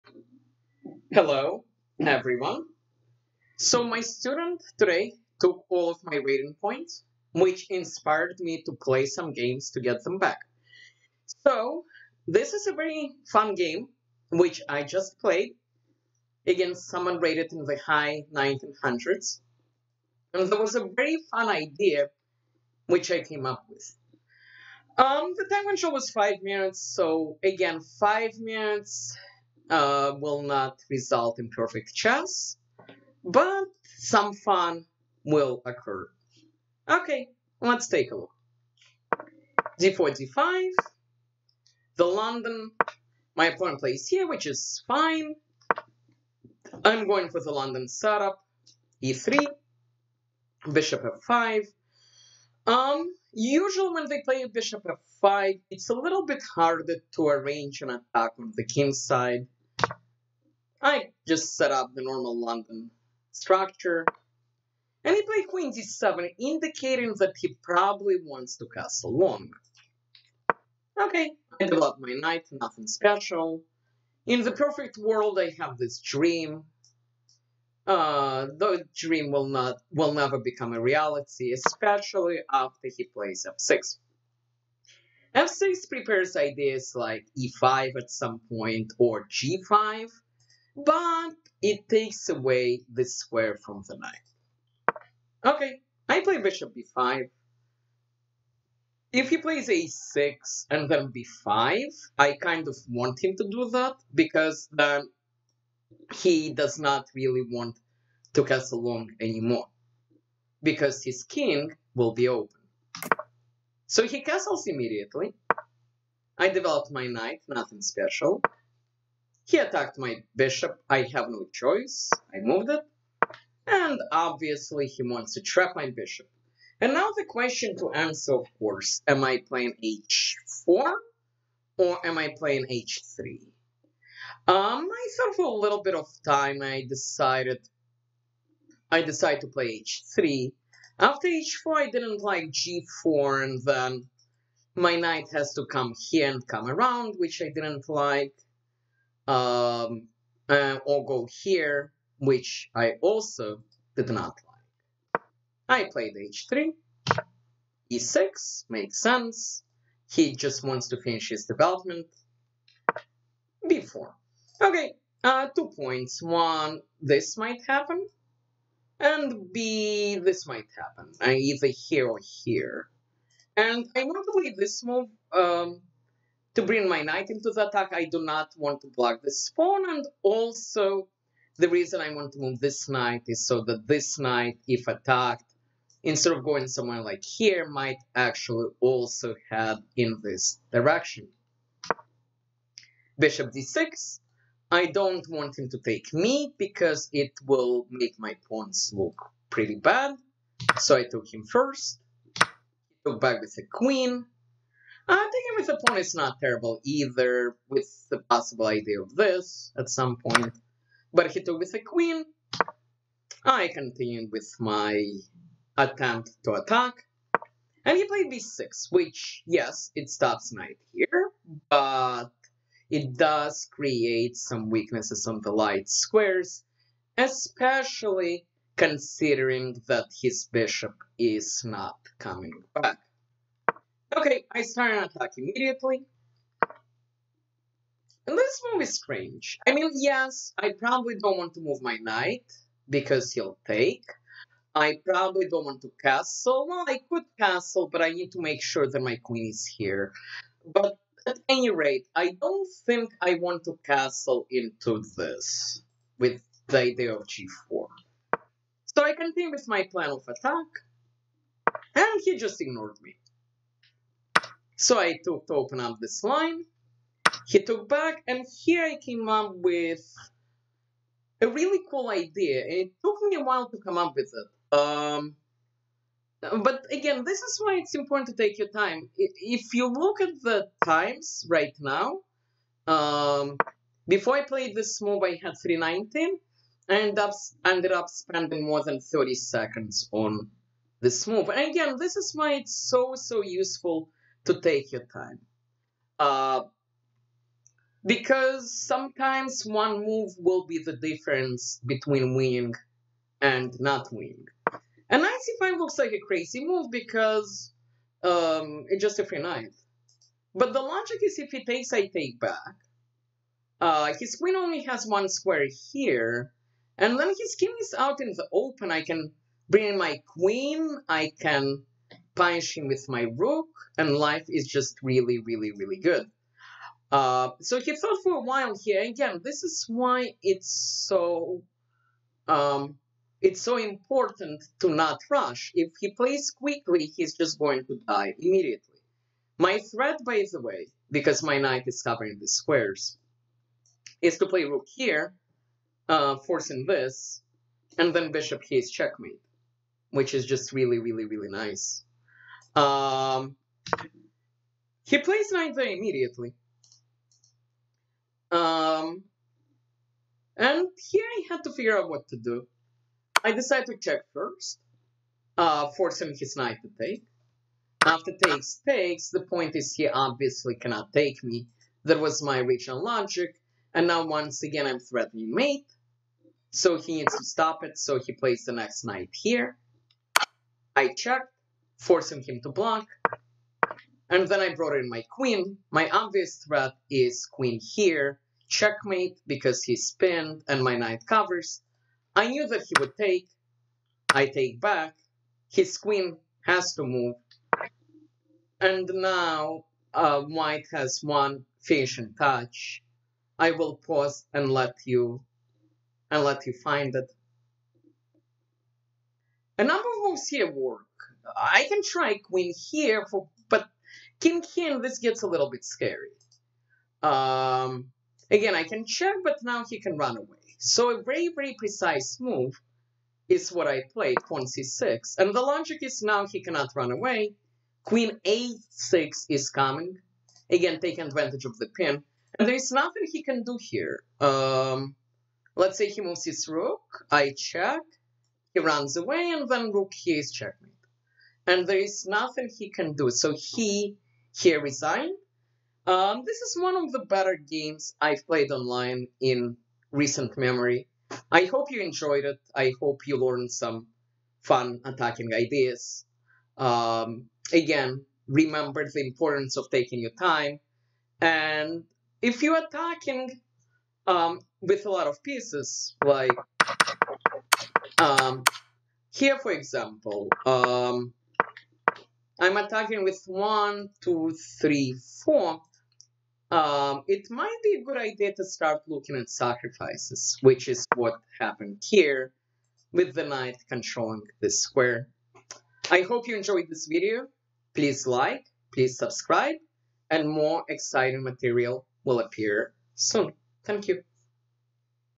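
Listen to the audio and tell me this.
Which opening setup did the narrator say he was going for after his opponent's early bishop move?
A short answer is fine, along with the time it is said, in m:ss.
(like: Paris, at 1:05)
London setup, at 0:47.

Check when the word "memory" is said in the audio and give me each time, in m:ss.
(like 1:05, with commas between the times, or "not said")
7:30.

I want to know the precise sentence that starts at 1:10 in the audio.
Okay, I developed my knight, nothing special.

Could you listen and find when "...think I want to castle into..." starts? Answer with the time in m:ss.
4:12.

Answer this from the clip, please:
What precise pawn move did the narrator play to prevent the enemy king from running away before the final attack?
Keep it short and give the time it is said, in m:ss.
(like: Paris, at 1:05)
c6, at 7:04.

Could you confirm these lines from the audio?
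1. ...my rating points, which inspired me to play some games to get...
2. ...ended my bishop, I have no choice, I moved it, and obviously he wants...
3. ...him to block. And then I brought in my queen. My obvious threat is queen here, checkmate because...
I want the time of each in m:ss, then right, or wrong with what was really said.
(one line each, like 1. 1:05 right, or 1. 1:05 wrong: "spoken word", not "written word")
1. 0:06 right
2. 1:59 wrong: "attacked", not "ended"
3. 6:22 right.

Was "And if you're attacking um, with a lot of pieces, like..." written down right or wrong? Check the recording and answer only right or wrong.
right.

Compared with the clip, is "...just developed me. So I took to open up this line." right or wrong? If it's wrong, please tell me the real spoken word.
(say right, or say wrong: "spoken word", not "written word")
wrong: "ignored", not "developed".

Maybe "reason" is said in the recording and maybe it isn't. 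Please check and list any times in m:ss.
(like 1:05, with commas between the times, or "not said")
3:01.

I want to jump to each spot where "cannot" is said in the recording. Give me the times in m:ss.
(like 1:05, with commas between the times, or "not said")
6:10, 7:06.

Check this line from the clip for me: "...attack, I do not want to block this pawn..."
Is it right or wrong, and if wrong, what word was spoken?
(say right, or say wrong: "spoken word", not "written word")
right.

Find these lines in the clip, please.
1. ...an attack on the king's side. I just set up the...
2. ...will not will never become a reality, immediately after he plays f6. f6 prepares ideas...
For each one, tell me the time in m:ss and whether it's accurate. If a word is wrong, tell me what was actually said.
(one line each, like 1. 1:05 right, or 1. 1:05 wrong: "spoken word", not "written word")
1. 0:57 right
2. 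1:19 wrong: "especially", not "immediately".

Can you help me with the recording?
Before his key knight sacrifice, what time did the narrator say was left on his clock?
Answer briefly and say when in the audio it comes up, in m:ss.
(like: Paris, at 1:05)
319, at 4:45.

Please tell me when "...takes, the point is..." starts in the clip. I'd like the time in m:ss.
6:08.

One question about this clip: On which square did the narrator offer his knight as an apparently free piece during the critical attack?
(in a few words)
c5.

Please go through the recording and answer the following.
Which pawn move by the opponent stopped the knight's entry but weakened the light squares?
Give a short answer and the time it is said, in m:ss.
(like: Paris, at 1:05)
b6, at 3:38.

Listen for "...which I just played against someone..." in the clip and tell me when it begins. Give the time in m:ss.
0:14.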